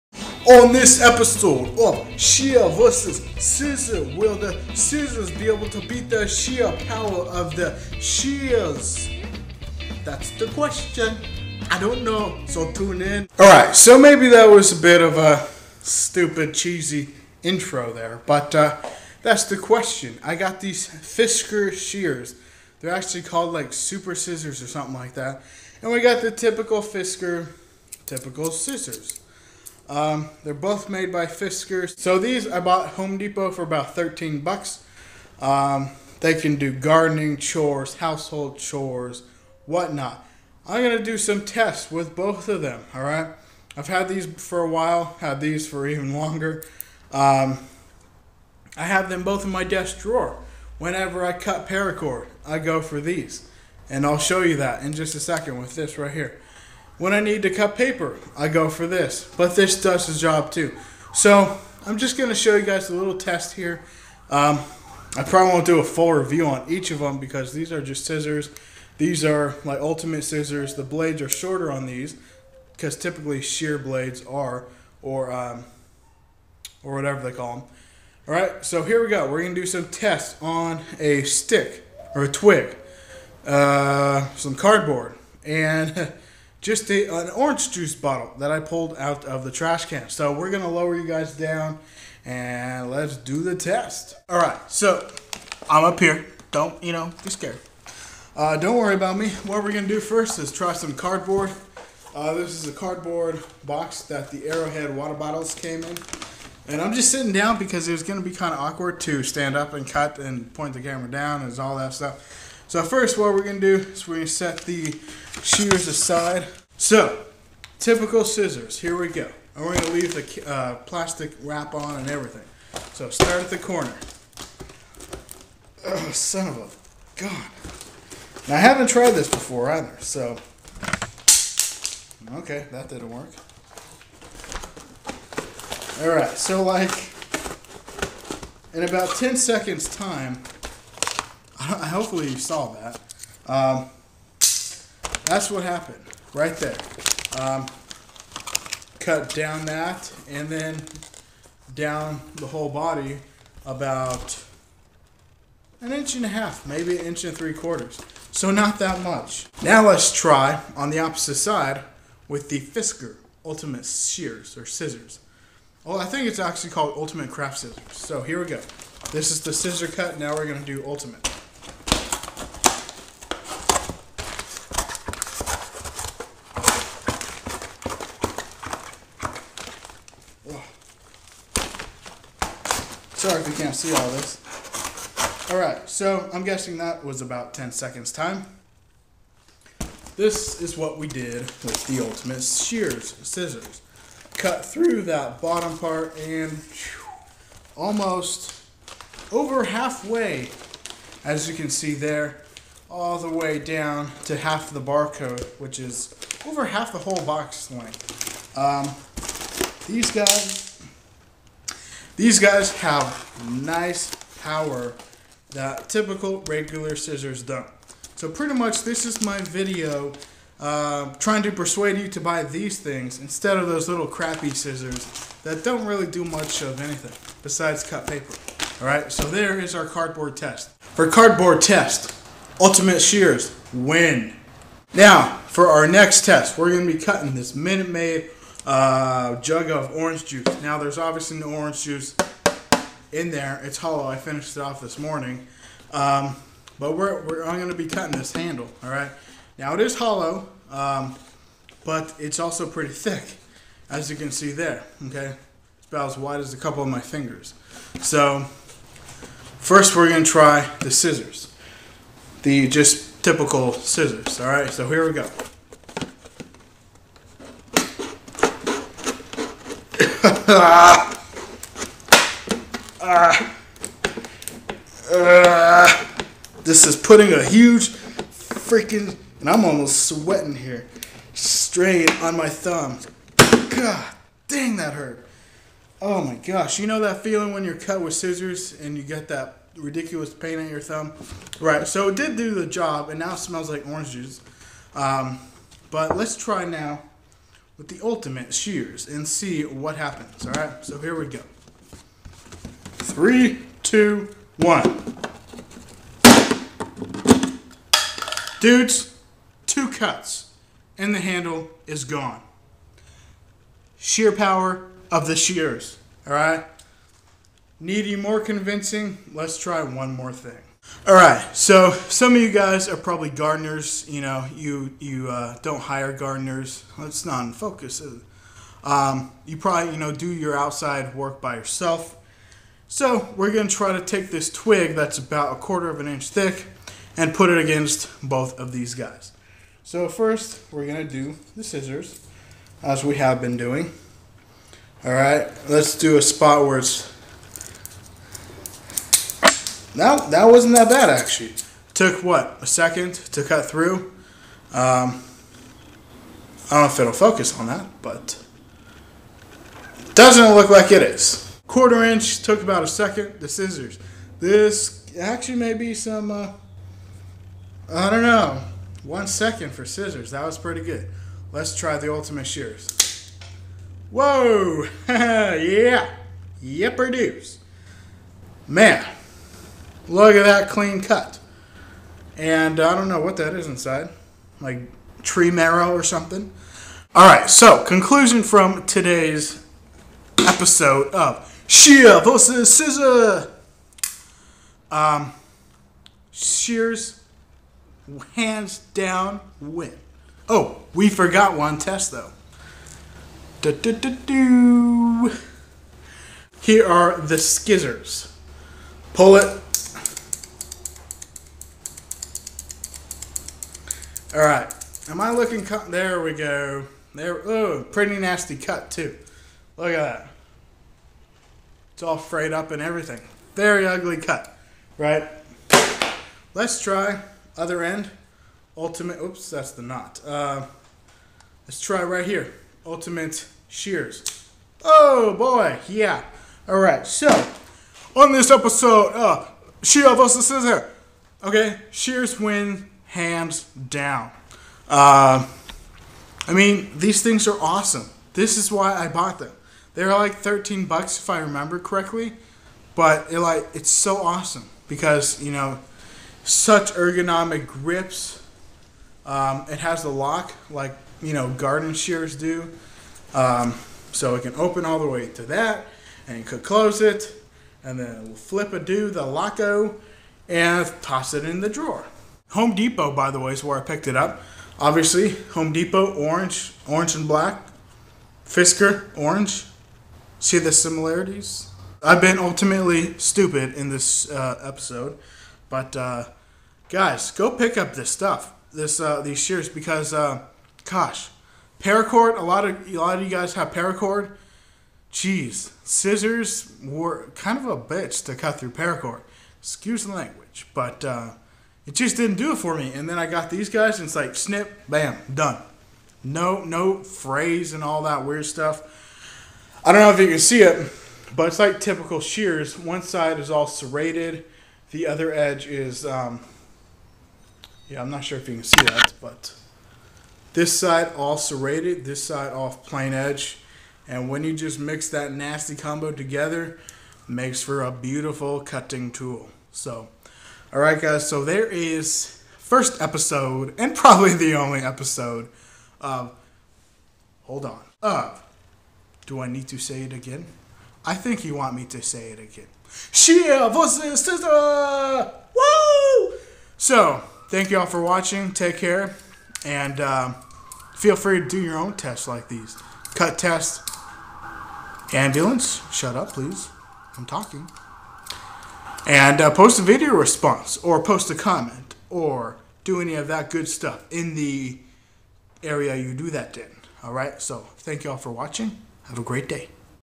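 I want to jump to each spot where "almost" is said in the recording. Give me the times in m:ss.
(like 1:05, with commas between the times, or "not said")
3:17, 4:39.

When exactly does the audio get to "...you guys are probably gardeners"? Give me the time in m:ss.
5:22.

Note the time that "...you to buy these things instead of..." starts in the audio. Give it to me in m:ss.
3:41.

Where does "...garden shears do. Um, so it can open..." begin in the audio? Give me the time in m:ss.
7:41.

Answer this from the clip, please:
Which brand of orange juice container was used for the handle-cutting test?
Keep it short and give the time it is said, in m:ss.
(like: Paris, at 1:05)
Minute Maid, at 3:57.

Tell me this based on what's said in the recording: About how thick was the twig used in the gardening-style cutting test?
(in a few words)
a quarter of an inch.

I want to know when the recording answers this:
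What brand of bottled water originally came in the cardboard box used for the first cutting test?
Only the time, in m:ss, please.
1:44.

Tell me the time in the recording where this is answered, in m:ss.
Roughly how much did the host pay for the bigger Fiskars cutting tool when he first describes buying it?
0:33.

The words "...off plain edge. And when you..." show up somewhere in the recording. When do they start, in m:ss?
8:42.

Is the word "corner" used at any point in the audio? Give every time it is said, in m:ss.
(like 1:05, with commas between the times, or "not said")
2:03.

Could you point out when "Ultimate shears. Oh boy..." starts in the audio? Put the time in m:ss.
7:12.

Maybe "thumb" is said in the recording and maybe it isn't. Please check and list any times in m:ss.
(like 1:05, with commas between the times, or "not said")
4:42, 4:50.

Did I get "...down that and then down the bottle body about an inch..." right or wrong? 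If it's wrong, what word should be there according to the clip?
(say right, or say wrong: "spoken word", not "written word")
wrong: "whole", not "bottle".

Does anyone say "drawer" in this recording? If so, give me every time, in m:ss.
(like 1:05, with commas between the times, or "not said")
0:49, 7:51.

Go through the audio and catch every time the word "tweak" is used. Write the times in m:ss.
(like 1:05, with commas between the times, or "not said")
not said.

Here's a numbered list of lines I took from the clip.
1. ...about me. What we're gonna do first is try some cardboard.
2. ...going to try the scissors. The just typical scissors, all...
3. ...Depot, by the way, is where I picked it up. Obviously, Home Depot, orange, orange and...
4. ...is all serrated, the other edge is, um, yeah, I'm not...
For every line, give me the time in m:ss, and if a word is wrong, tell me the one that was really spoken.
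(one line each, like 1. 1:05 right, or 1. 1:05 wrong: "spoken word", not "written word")
1. 1:38 right
2. 4:20 right
3. 7:52 right
4. 8:33 right.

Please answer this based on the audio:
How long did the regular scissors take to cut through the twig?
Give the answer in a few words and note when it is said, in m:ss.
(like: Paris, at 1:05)
1 second, at 6:09.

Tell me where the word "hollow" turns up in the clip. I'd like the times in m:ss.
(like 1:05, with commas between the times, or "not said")
4:03, 4:09.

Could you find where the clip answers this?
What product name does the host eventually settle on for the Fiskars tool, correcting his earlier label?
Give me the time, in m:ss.
2:46.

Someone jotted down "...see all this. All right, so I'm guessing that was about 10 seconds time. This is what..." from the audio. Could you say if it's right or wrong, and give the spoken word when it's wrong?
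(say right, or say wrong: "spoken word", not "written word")
right.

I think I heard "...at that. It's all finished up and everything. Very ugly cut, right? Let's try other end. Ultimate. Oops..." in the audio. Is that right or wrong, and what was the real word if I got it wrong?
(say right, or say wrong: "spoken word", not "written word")
wrong: "frayed", not "finished".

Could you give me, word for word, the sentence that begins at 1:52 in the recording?
So first what we're gonna do is we're gonna set the shears aside.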